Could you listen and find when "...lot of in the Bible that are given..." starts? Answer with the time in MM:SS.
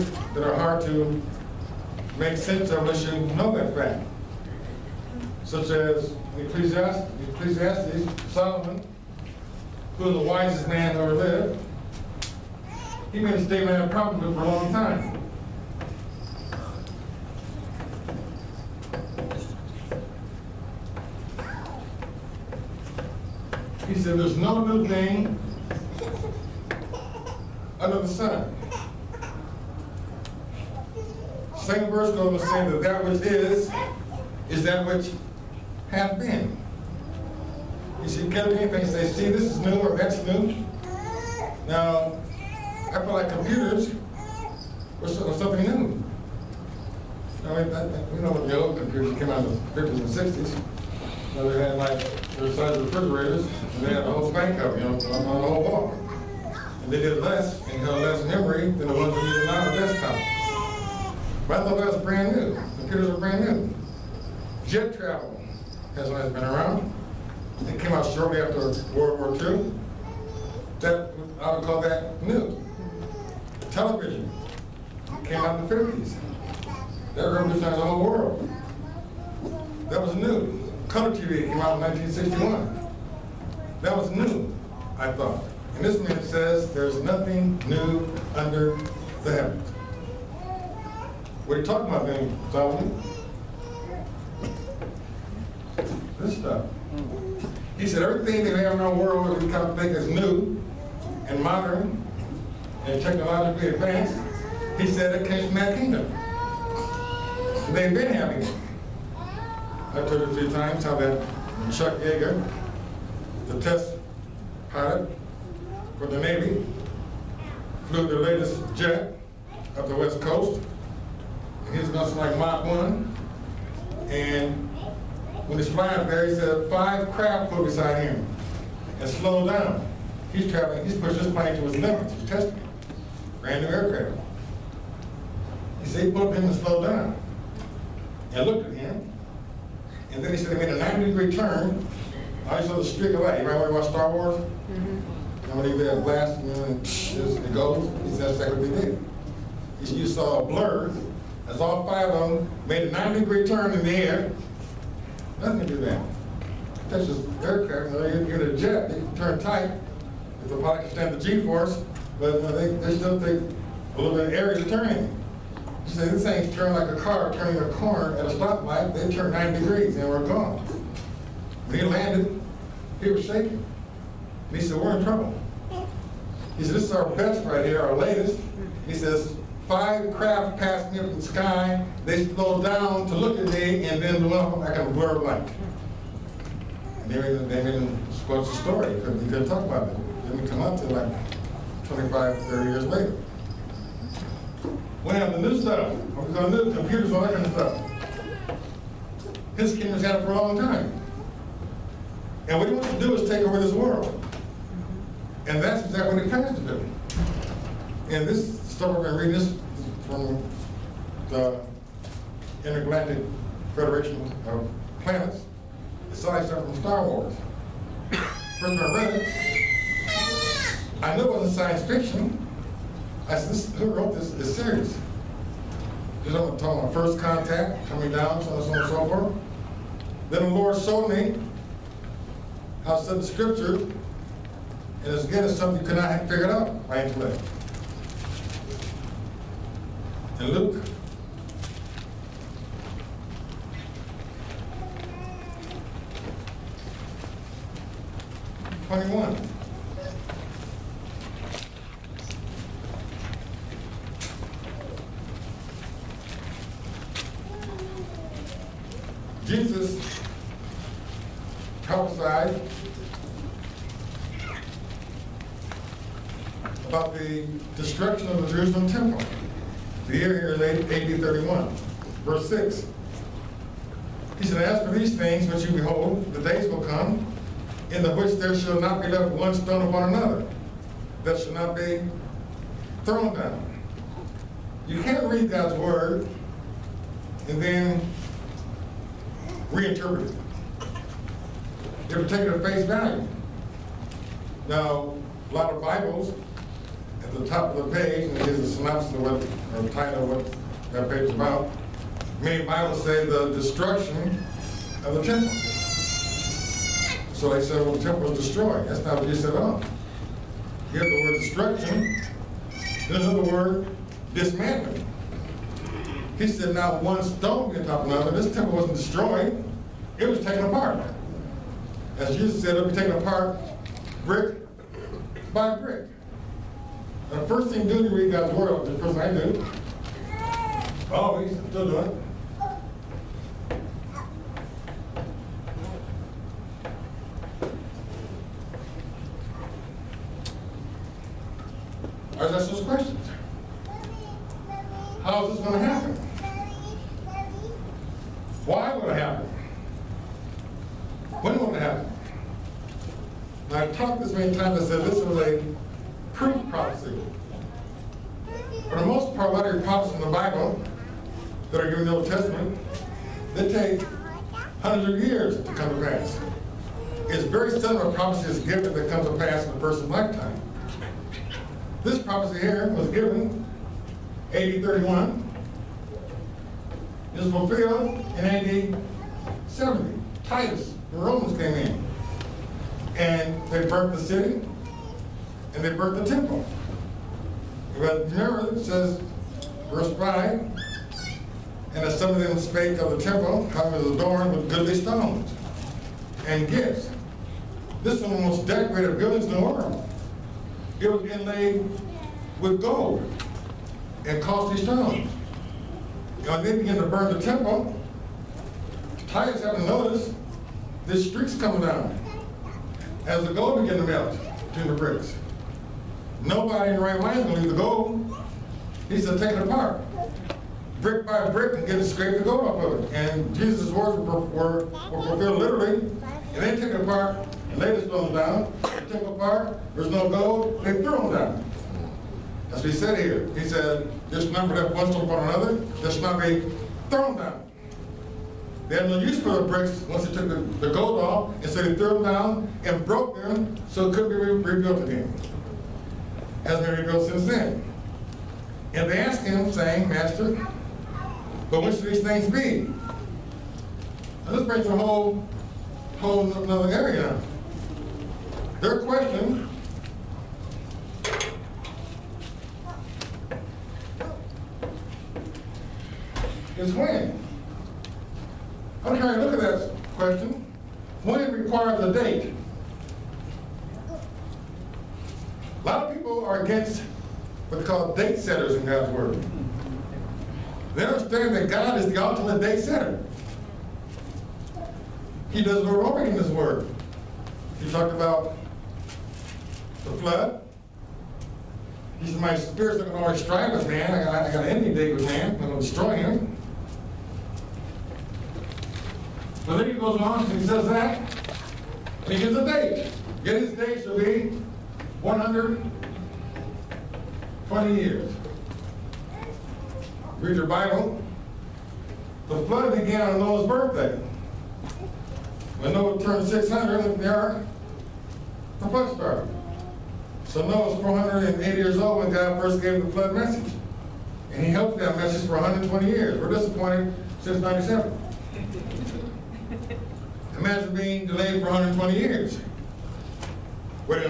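05:59.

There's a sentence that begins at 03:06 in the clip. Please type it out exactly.
And they made, they made him the story.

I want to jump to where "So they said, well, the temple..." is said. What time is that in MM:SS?
05:07.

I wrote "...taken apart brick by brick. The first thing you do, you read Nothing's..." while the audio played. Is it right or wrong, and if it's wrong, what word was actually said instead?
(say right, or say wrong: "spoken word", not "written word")
wrong: "God", not "Nothing".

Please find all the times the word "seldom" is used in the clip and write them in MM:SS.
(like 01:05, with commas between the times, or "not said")
06:07.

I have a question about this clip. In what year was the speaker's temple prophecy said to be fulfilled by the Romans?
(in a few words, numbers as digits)
AD 70.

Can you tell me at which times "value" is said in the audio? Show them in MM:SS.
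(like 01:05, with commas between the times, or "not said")
04:52.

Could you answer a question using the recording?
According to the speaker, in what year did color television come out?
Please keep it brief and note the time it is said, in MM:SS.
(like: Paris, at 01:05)
1961, at 01:21.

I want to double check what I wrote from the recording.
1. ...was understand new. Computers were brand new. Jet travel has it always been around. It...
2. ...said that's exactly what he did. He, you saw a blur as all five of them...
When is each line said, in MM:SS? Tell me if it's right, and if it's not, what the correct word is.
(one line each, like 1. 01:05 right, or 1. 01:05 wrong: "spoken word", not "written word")
1. 01:01 wrong: "brand", not "understand"
2. 02:28 right.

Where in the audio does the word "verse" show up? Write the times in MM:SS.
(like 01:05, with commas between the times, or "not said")
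00:31, 04:32, 06:29.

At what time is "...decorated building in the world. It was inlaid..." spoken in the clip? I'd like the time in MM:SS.
06:38.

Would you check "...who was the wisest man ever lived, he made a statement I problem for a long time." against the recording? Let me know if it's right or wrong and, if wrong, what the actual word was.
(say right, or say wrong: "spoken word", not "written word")
right.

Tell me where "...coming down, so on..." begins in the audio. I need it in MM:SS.
03:47.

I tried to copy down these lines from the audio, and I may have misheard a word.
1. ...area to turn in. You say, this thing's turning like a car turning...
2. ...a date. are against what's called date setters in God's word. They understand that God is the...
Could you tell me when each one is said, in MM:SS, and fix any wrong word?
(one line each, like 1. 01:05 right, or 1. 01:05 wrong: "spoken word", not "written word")
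1. 02:44 right
2. 07:52 right.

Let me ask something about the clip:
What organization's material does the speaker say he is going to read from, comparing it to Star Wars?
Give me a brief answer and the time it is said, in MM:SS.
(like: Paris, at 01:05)
Intergalactic Federation of Planets, at 03:32.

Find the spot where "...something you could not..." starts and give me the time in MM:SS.
03:55.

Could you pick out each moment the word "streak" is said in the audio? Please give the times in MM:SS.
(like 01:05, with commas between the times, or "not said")
02:22, 06:51.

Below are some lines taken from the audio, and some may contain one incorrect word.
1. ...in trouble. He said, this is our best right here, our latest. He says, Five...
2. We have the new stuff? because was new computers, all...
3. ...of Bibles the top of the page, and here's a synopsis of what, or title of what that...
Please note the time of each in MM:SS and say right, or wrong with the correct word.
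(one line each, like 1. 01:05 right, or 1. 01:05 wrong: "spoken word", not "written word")
1. 02:54 right
2. 03:15 right
3. 04:55 right.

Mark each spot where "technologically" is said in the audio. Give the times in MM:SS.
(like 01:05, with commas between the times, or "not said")
01:43.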